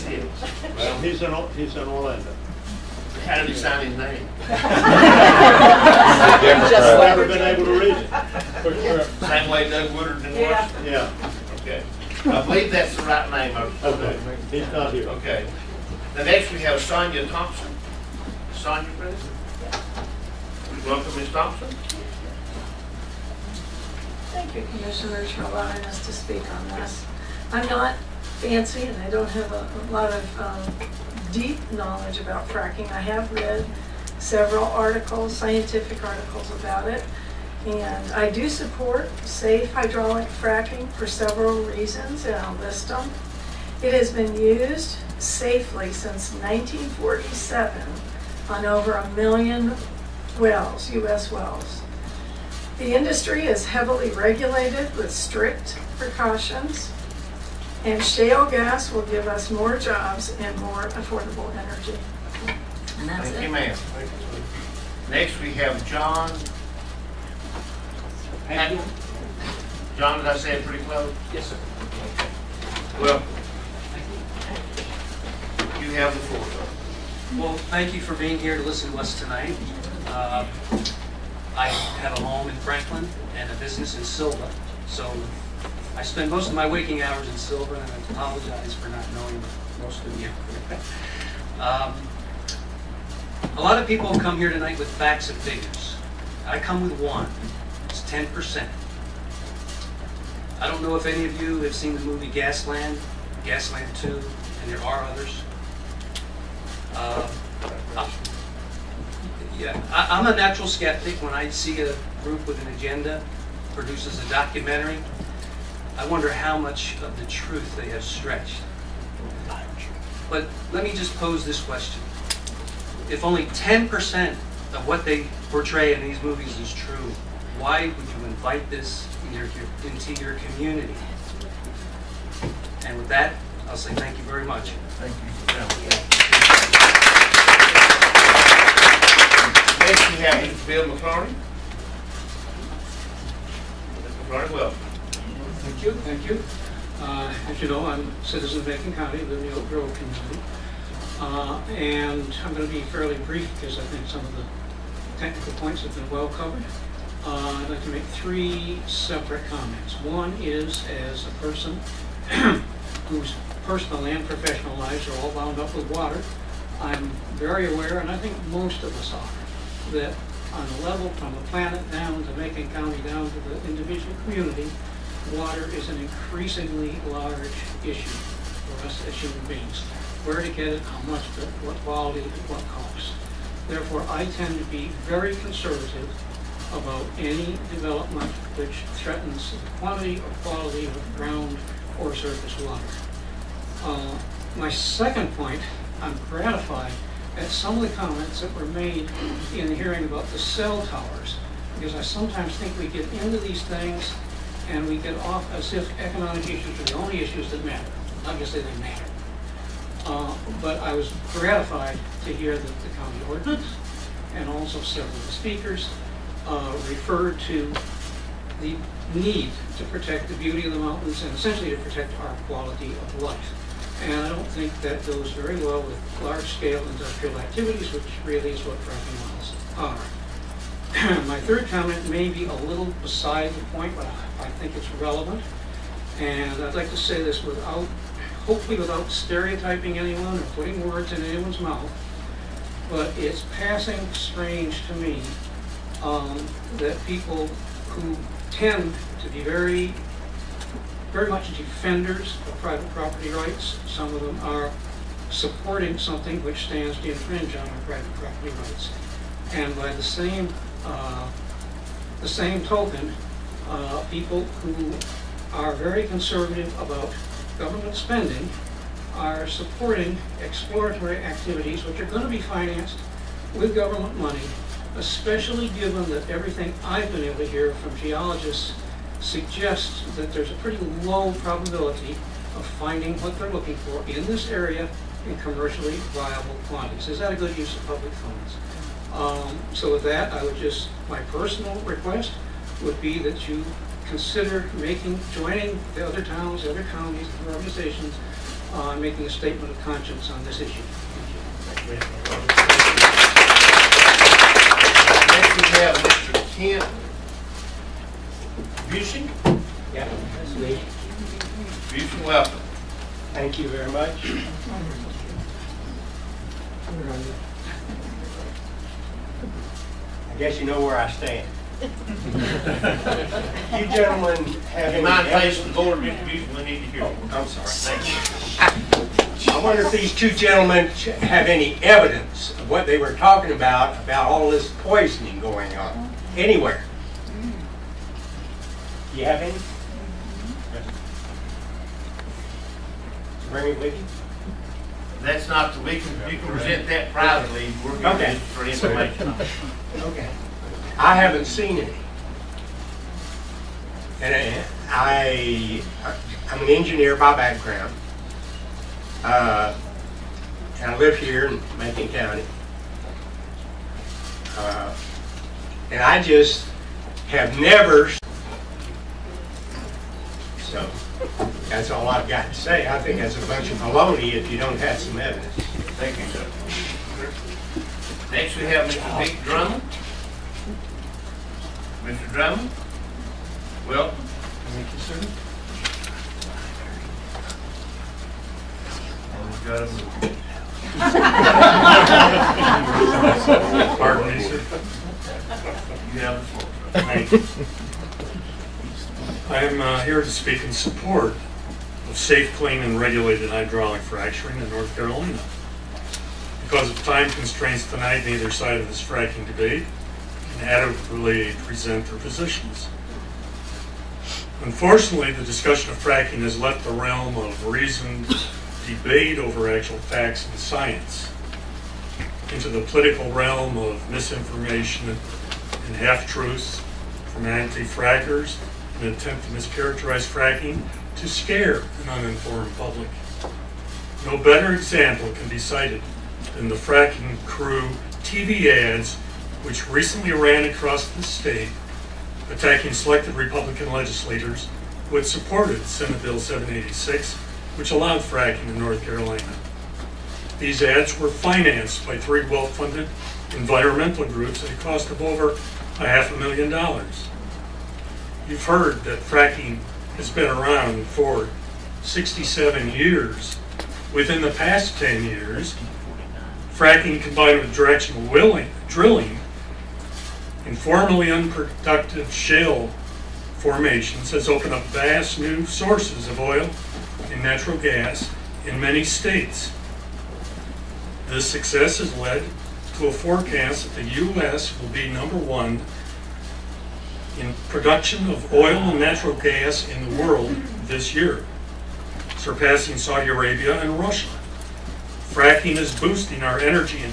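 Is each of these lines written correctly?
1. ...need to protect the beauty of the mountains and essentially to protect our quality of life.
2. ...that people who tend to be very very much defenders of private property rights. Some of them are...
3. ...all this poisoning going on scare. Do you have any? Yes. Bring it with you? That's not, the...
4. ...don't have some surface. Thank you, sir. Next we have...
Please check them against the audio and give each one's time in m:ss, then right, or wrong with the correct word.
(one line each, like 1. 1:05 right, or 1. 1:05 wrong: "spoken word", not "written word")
1. 3:39 right
2. 4:06 right
3. 5:34 wrong: "anywhere", not "scare"
4. 6:14 wrong: "evidence", not "surface".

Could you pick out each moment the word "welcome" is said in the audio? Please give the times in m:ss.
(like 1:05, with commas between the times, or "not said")
0:20, 6:23.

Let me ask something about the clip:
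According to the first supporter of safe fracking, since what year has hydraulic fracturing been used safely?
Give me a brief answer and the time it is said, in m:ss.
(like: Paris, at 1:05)
1947, at 0:46.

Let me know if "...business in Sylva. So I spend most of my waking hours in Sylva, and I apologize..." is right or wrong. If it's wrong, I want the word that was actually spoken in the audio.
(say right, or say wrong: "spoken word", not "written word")
right.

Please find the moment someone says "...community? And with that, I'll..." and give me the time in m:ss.
2:10.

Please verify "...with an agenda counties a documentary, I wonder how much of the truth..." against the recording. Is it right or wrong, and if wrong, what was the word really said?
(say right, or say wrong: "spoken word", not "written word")
wrong: "produces", not "counties".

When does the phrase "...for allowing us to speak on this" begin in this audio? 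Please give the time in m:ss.
0:25.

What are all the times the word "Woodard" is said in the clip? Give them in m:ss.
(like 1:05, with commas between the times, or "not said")
0:09.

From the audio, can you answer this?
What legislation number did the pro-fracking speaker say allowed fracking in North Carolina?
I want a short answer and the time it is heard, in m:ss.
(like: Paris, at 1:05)
Senate Bill 786, at 7:25.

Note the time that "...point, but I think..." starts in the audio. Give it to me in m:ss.
3:53.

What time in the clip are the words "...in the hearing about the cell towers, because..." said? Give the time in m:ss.
3:19.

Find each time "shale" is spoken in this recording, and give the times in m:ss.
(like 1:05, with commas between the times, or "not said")
0:58, 7:52.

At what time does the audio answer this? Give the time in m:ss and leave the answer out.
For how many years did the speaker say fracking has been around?
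7:42.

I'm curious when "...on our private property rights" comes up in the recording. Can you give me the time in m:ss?
4:17.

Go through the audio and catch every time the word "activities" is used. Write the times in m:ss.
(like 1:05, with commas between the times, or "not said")
3:47, 4:31.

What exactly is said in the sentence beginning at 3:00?
Where to get it, how much, it, what quality, what cost.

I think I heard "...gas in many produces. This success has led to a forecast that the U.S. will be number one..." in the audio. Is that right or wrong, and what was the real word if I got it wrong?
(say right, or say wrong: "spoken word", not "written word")
wrong: "states", not "produces".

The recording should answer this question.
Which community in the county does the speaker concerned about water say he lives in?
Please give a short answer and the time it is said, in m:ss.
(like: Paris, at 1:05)
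Oak Grove, at 2:29.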